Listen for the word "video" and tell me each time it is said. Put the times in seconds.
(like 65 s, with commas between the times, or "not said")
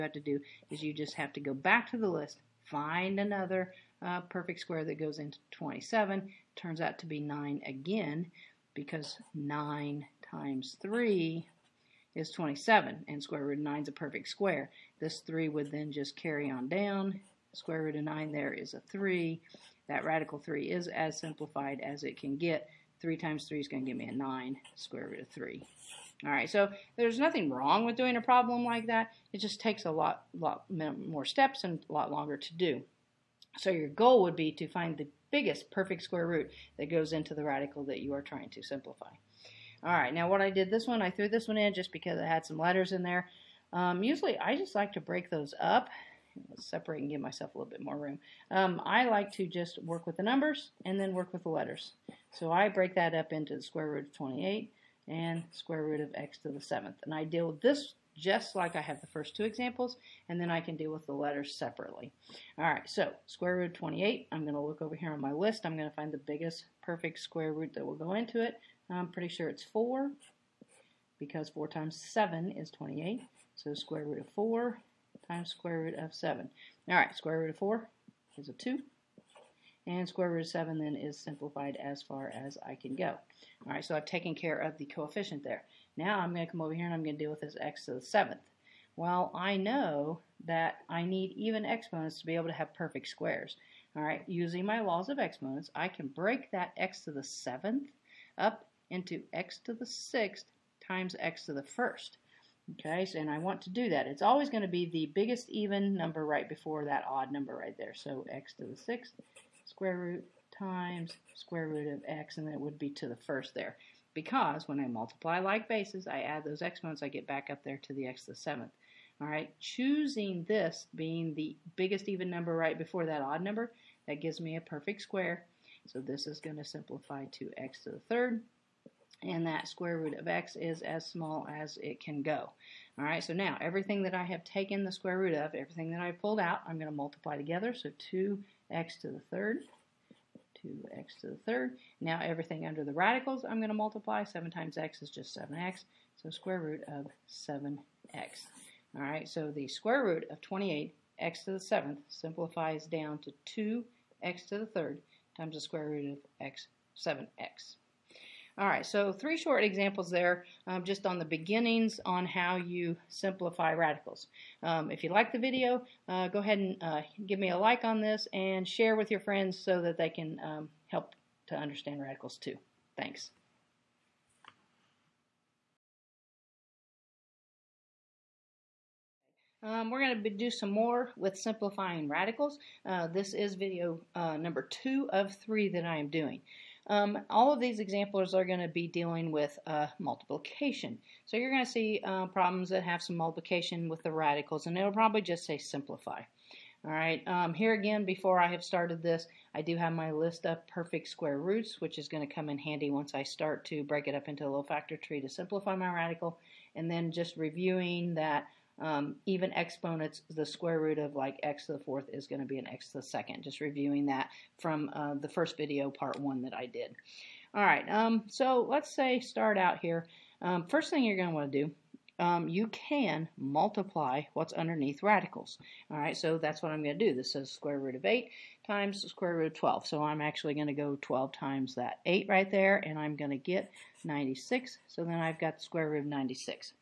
165 s, 183 s, 215 s.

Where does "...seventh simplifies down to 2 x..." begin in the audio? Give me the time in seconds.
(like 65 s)
151 s.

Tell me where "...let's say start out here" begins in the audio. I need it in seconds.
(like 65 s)
218 s.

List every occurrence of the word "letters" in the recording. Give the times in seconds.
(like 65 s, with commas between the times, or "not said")
42 s, 51 s, 61 s.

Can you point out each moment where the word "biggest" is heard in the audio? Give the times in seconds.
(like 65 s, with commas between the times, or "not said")
35 s, 66 s, 105 s, 121 s.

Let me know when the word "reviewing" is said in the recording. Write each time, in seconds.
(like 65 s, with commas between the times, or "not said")
207 s, 213 s.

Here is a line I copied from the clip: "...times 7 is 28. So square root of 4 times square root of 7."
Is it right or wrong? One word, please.
right.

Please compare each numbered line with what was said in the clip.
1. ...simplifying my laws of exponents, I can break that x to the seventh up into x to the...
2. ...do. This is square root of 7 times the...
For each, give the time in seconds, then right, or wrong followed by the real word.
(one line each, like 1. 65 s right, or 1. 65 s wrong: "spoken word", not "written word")
1. 94 s wrong: "using", not "simplifying"
2. 227 s wrong: "8", not "7".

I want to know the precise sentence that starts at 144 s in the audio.
7 times x is just 7x, so square root of 7x.